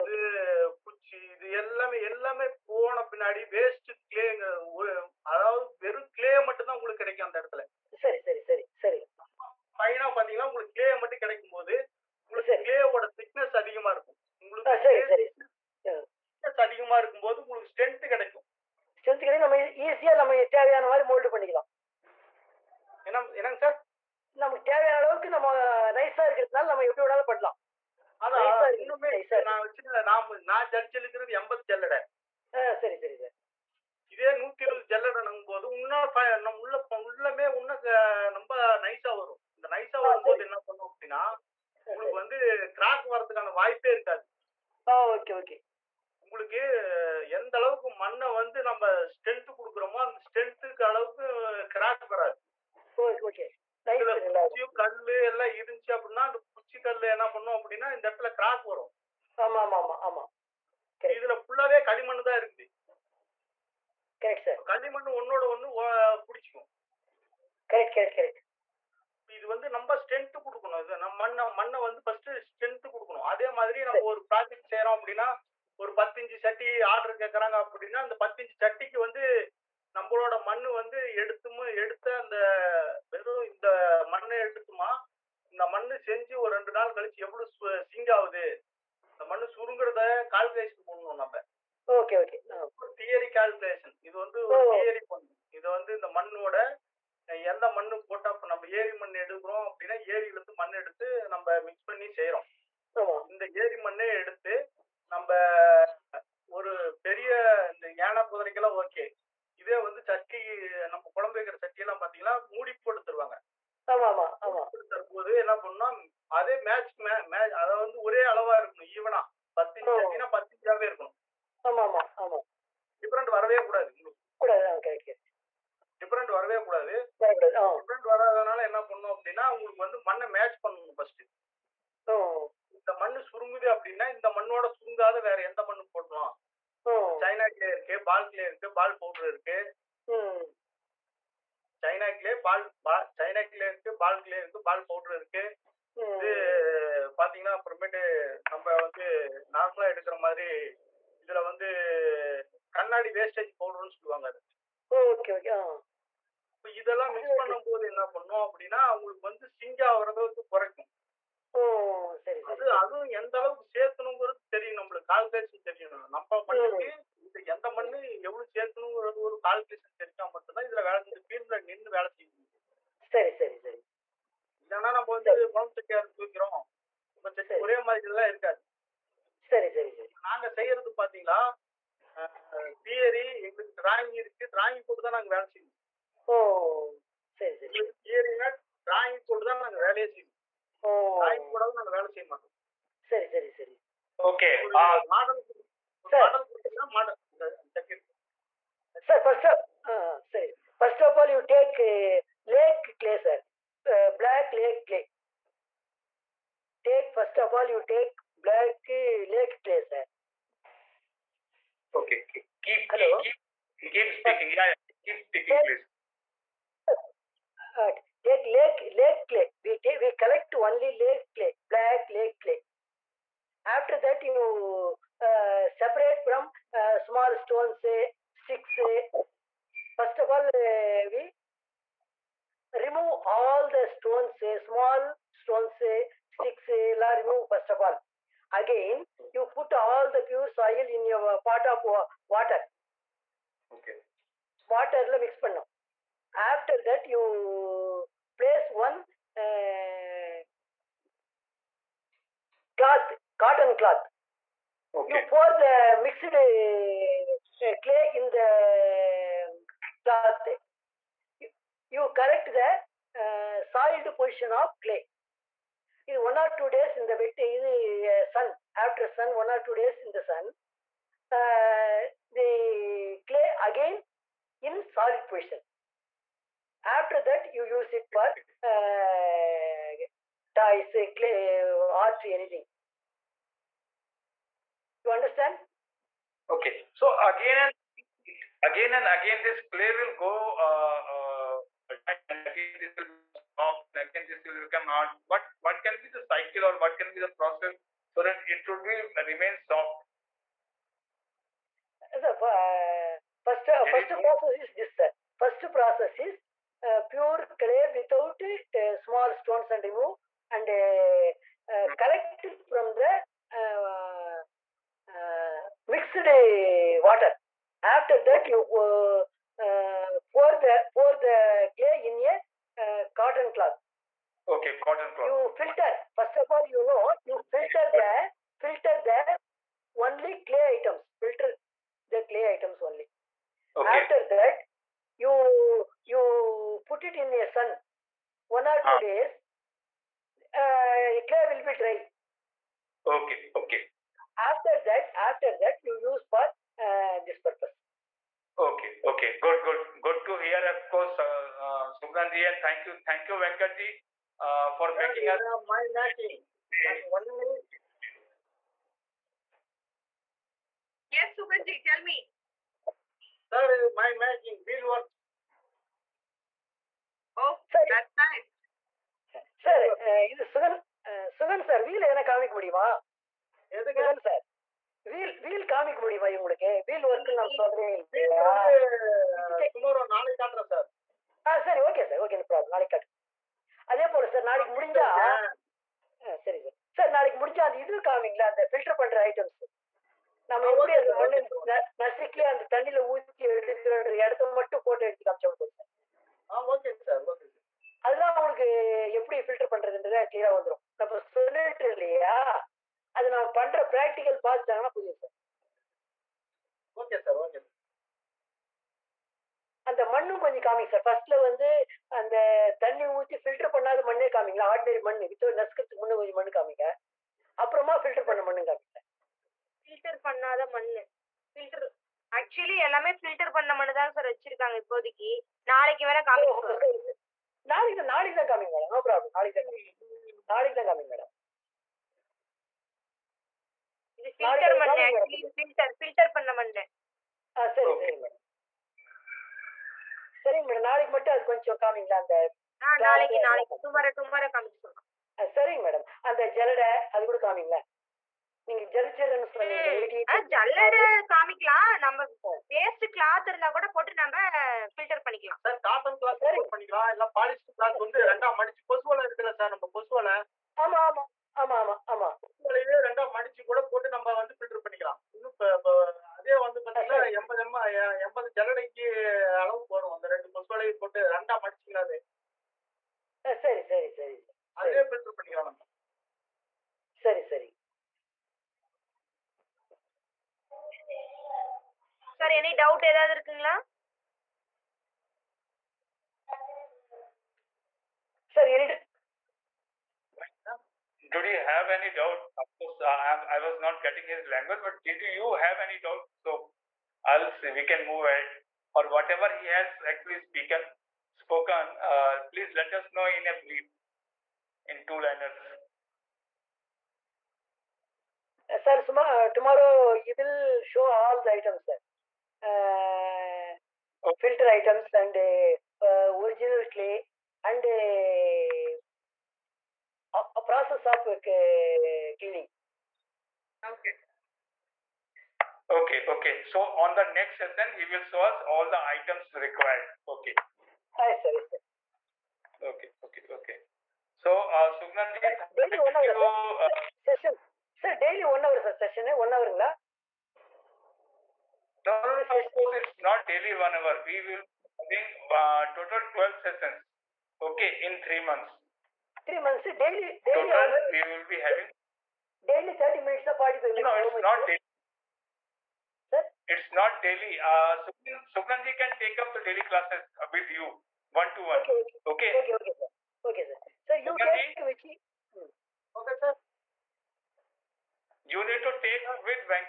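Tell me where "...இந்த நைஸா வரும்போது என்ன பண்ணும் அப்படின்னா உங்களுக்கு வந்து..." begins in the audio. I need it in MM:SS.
00:39.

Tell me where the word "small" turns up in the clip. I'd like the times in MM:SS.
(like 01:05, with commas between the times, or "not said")
03:46, 03:54, 05:08.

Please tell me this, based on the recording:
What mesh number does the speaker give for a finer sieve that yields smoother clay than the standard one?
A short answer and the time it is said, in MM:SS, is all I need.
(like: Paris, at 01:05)
120, at 00:34.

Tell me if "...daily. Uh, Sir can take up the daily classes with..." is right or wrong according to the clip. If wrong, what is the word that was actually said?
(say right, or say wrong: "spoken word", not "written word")
wrong: "Sugnanji", not "Sir".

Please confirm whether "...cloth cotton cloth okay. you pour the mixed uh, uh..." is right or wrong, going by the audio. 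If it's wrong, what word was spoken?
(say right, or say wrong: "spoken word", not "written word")
right.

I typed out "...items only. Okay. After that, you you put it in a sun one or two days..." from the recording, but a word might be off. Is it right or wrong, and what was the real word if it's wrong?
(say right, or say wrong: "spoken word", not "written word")
right.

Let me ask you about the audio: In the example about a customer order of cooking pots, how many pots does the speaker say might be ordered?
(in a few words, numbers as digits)
15.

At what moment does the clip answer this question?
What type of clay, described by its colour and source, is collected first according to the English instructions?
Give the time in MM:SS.
03:41.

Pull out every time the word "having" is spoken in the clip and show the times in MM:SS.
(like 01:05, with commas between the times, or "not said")
09:04, 09:11.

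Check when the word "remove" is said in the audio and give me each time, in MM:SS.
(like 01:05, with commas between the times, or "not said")
03:52, 03:57, 05:09.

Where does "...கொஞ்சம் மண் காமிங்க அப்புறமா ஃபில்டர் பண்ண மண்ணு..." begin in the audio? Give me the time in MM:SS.
06:56.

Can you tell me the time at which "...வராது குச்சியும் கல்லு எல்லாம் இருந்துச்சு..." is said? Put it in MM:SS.
00:52.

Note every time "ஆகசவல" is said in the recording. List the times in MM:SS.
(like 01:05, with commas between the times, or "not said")
07:02, 07:15.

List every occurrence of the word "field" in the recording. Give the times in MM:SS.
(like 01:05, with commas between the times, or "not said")
06:04.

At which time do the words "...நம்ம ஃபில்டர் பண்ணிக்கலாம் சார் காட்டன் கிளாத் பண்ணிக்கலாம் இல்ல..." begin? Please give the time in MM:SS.
07:34.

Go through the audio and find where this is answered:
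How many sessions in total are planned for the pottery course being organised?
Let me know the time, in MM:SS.
09:06.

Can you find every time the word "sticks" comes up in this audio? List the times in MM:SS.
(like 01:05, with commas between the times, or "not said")
03:48, 03:56.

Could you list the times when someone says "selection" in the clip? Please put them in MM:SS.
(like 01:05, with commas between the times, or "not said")
not said.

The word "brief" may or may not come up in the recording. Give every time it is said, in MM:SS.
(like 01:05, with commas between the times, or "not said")
08:23.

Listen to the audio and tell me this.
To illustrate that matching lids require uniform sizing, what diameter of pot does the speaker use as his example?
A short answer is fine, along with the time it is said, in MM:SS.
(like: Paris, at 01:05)
10 inches, at 01:59.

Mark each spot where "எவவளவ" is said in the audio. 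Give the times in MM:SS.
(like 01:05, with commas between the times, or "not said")
01:27, 02:48.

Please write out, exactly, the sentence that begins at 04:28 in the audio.
After sun, one or two days in the sun, uh, the clay again in solid position.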